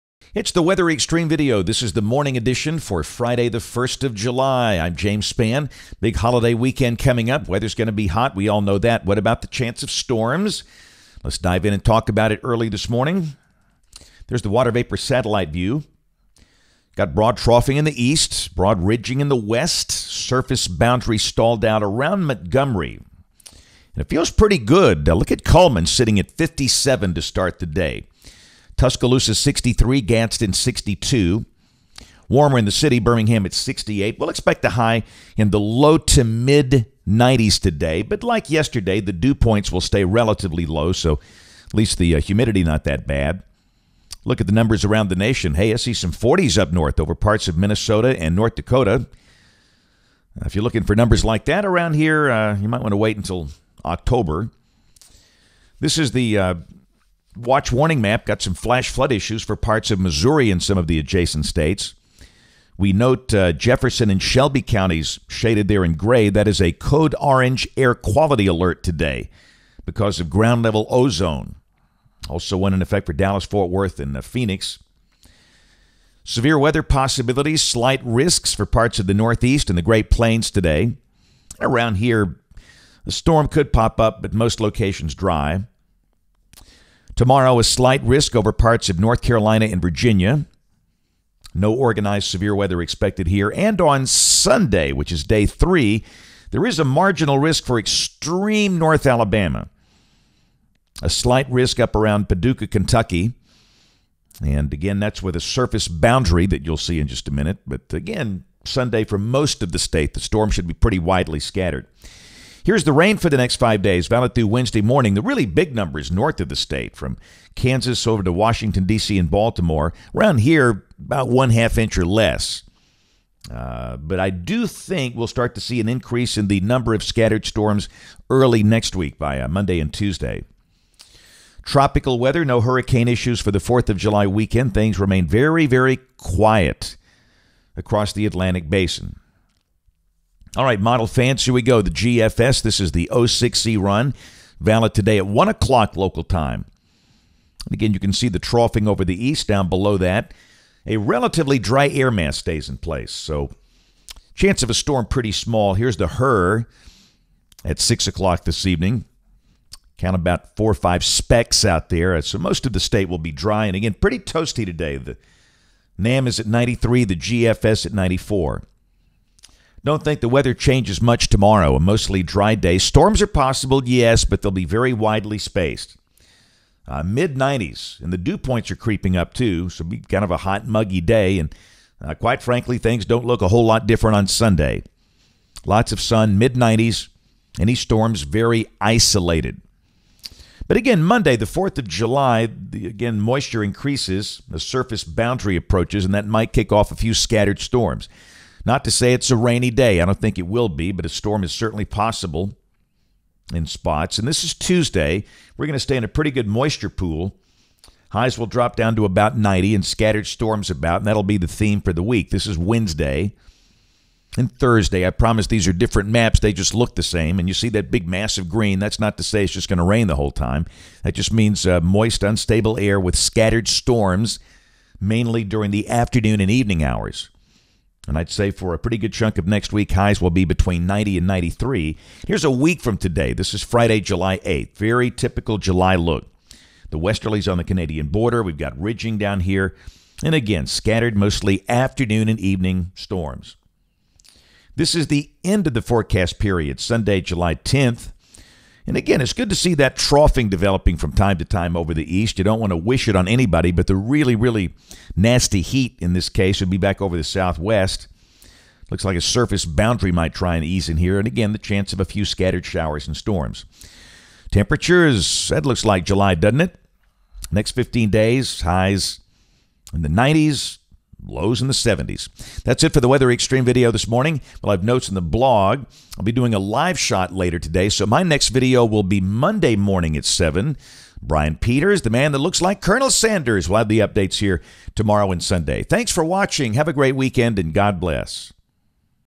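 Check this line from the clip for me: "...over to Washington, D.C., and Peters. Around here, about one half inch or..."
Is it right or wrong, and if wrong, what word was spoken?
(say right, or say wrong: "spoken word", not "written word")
wrong: "Baltimore", not "Peters".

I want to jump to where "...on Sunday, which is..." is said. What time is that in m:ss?
1:33.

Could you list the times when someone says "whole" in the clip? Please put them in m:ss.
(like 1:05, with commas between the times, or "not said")
3:03, 3:40.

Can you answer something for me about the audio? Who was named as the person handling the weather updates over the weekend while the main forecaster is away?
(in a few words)
Brian Peters.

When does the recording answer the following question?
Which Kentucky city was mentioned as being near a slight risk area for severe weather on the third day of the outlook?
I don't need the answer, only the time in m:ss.
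1:42.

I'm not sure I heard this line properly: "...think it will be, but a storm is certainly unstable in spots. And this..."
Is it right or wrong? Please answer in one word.
wrong.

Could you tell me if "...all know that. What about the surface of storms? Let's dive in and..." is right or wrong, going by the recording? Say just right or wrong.
wrong.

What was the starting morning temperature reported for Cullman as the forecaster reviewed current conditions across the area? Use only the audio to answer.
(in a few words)
57.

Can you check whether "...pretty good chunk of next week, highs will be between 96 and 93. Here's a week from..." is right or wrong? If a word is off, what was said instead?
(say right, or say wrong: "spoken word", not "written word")
wrong: "90", not "96".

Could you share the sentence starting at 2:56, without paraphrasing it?
Uh, Mid 90s, and the dew points are creeping up too, so be kind of a hot, muggy day.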